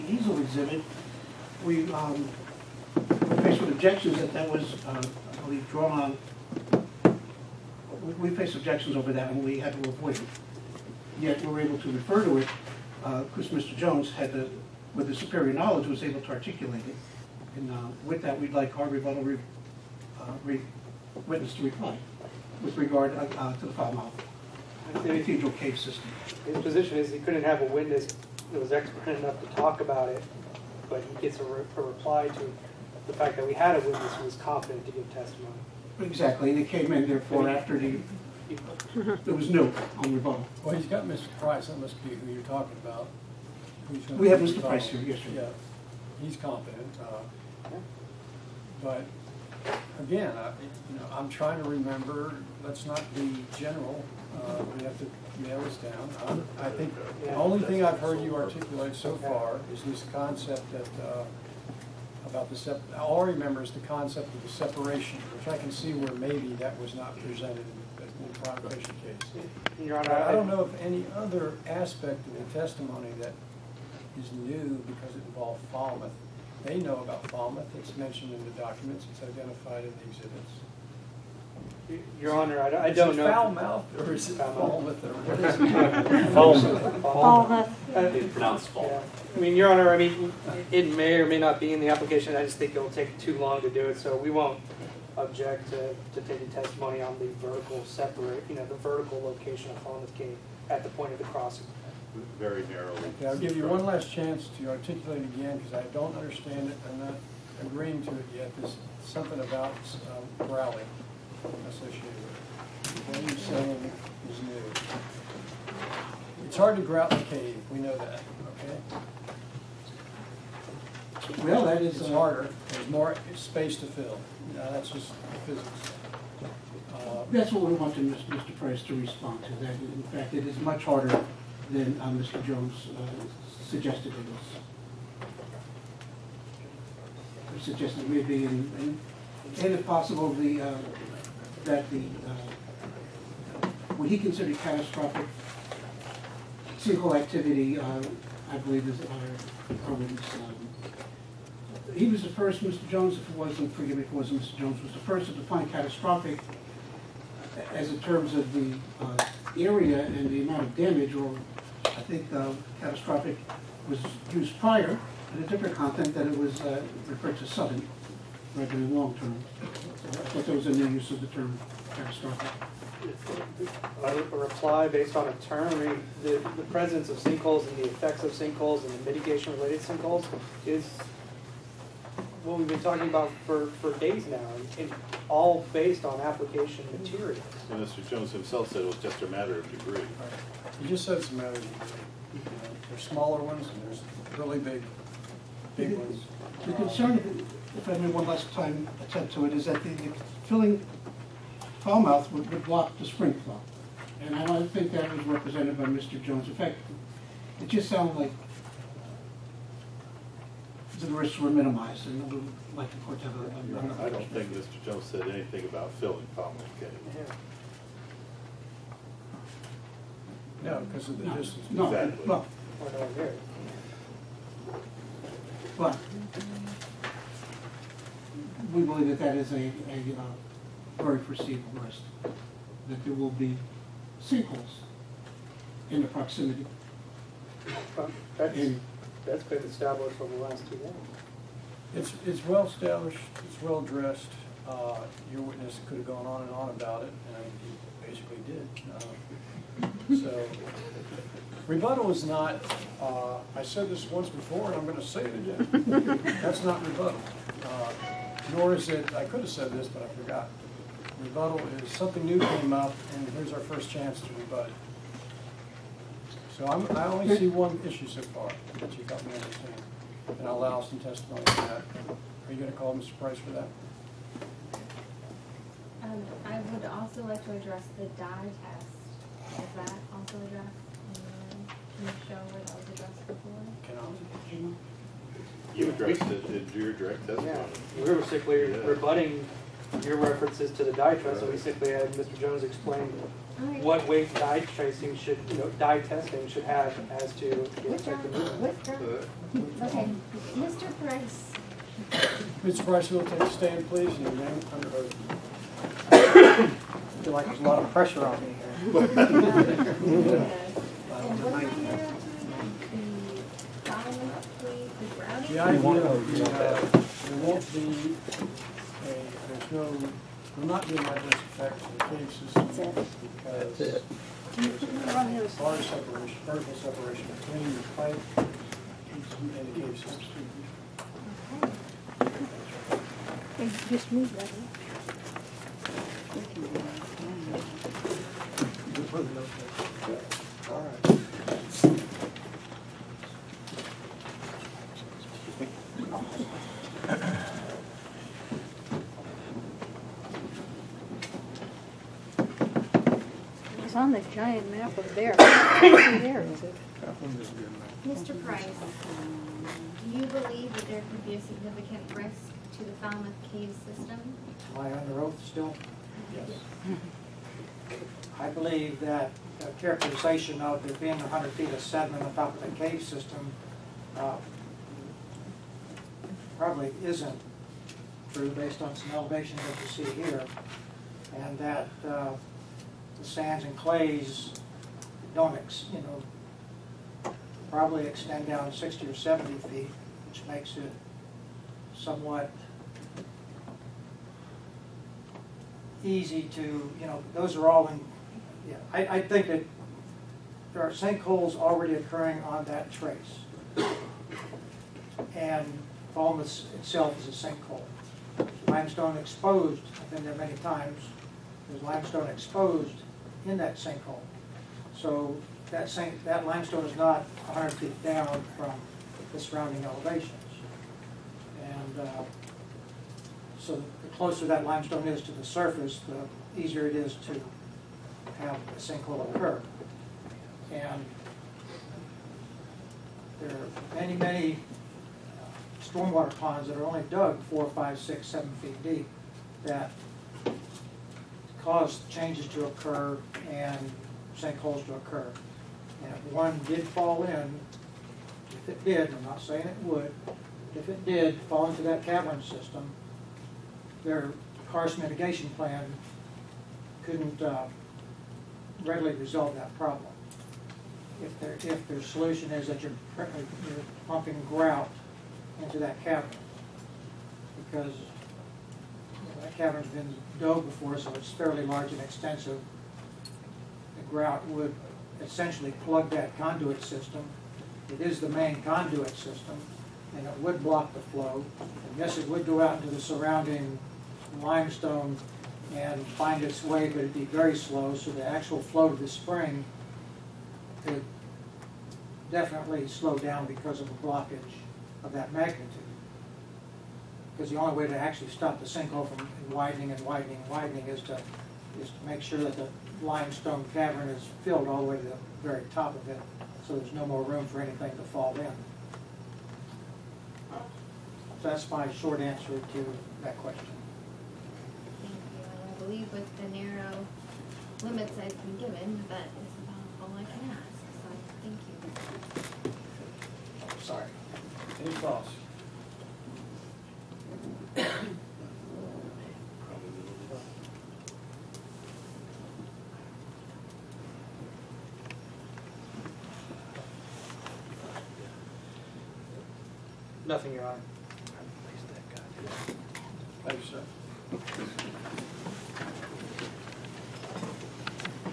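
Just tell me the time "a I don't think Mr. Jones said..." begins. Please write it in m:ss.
3:34.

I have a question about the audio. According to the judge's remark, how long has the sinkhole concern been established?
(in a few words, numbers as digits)
two years.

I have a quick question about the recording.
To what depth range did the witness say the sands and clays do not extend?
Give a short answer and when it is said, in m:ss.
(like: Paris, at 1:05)
60 or 70 feet, at 6:28.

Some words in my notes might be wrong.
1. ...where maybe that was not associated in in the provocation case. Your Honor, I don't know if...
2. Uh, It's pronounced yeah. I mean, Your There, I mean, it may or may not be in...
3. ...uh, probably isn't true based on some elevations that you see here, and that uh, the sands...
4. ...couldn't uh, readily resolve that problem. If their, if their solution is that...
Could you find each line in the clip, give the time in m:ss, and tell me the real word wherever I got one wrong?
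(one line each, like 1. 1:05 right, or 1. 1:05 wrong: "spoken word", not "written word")
1. 1:05 wrong: "presented", not "associated"
2. 1:27 wrong: "Honor", not "There"
3. 6:14 right
4. 7:37 right.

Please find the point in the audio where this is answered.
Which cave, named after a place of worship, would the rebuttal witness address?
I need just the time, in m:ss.
0:24.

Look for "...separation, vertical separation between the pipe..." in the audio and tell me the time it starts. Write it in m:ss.
5:25.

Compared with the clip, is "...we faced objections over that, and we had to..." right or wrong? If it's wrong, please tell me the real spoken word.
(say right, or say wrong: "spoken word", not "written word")
right.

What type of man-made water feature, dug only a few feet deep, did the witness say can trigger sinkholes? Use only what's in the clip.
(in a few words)
stormwater ponds.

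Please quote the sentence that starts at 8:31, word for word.
So that's my short answer to that question.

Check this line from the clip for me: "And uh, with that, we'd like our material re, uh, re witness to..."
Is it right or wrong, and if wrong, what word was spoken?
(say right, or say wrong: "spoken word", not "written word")
wrong: "rebuttal", not "material".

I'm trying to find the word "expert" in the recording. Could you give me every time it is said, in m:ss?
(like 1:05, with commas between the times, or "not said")
0:28.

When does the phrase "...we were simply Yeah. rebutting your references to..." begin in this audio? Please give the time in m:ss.
4:48.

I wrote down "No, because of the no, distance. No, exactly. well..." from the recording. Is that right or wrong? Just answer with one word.
right.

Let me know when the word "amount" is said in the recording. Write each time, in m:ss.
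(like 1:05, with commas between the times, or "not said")
2:40.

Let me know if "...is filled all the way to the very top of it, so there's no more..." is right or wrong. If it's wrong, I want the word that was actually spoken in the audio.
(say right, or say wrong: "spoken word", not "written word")
right.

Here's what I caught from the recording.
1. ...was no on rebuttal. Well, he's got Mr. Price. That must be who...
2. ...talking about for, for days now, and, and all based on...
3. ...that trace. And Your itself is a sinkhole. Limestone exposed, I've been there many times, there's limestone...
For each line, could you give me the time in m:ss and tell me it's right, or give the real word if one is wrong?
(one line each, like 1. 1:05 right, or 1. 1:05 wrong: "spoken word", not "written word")
1. 0:39 right
2. 3:02 right
3. 6:42 wrong: "Falmouth", not "Your".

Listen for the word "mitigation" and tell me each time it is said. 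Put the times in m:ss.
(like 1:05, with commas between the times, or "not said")
2:59, 7:34.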